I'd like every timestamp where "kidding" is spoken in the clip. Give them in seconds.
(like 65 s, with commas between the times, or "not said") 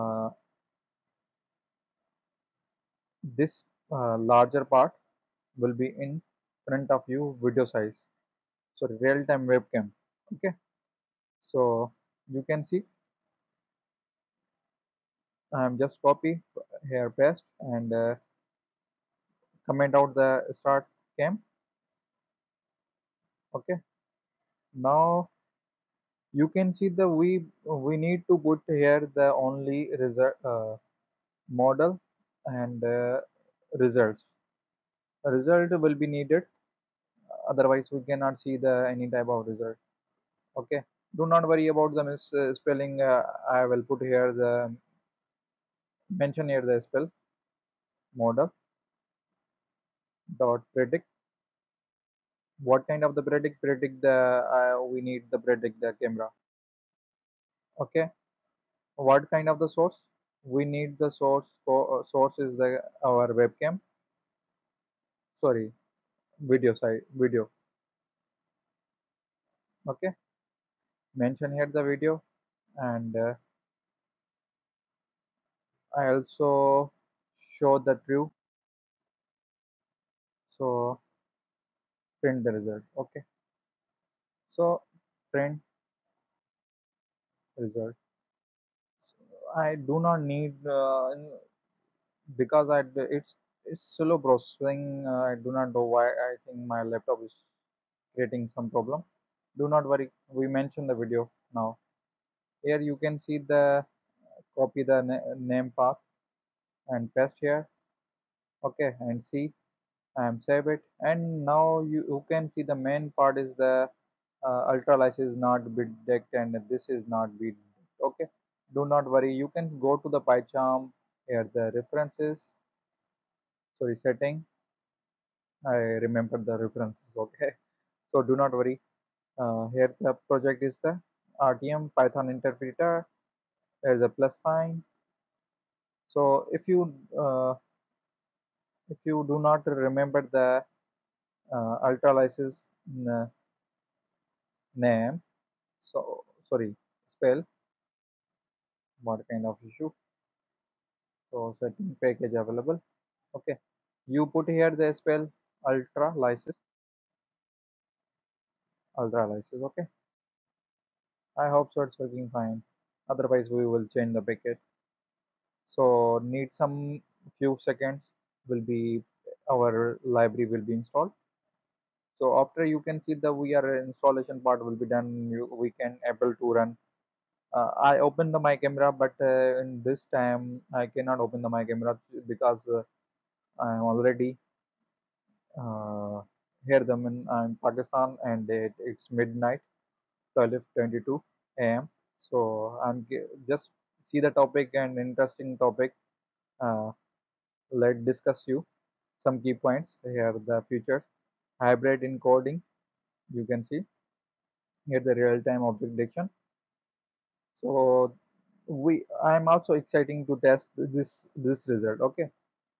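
not said.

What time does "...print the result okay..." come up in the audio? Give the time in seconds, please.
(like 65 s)
82 s.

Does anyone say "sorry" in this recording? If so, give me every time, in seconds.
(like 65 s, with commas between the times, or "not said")
65 s, 123 s, 146 s.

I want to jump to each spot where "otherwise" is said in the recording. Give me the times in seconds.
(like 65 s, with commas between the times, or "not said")
37 s, 163 s.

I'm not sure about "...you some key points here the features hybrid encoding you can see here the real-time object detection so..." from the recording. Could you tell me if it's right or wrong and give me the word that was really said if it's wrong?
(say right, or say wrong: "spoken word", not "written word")
right.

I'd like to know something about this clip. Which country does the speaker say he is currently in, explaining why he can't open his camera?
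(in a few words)
Pakistan.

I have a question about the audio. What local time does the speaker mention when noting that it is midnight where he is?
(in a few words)
12:22 a.m.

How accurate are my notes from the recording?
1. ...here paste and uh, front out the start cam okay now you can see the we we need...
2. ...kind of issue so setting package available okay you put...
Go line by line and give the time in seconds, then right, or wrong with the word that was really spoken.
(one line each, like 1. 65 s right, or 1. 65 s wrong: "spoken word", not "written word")
1. 16 s wrong: "comment", not "front"
2. 149 s right.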